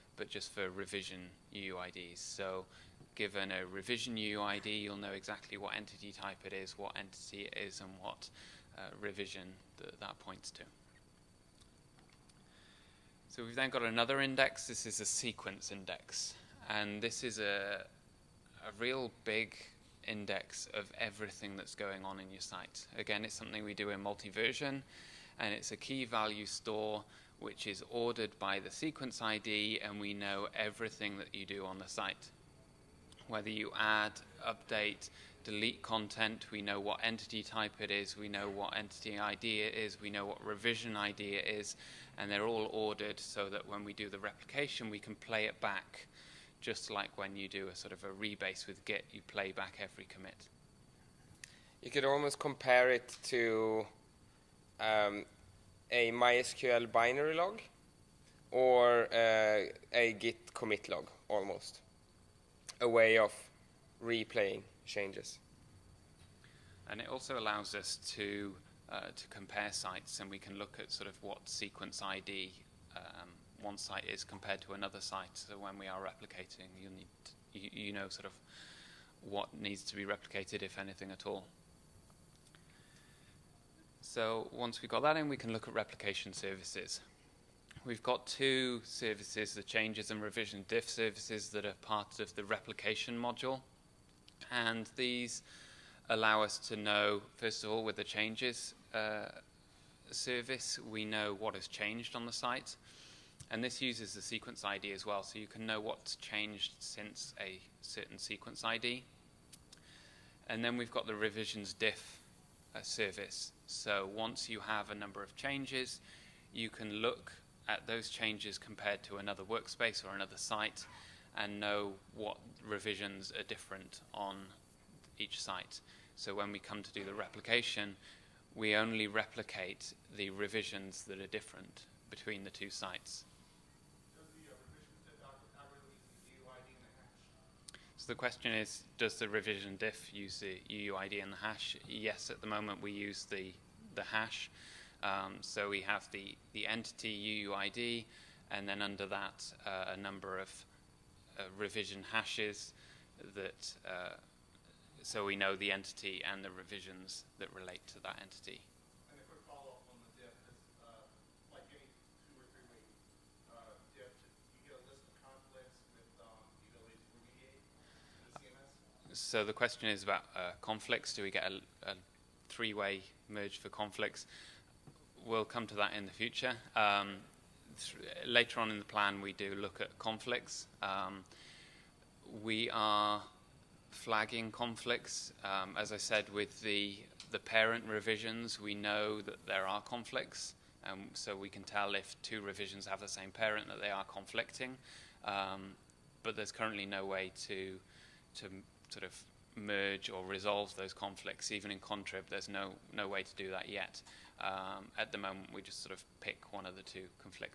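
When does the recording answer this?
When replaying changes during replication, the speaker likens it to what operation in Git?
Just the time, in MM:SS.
00:48.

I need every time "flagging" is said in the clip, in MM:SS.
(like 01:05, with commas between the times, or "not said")
03:03.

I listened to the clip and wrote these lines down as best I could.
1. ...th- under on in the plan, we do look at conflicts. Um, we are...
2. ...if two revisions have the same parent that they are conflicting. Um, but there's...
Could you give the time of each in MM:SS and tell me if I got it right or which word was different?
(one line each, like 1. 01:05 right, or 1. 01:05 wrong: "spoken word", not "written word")
1. 02:57 wrong: "later", not "under"
2. 03:11 right.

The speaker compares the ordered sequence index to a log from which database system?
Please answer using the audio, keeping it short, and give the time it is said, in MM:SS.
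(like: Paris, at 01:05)
MySQL, at 00:56.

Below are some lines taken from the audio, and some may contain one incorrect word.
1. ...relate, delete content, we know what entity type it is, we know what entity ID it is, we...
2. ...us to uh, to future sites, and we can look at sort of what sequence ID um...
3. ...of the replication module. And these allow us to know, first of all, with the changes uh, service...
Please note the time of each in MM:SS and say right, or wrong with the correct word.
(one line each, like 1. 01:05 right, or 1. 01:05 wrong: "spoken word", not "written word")
1. 00:34 wrong: "update", not "relate"
2. 01:07 wrong: "compare", not "future"
3. 01:32 right.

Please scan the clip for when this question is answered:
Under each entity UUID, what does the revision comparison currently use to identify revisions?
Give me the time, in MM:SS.
02:31.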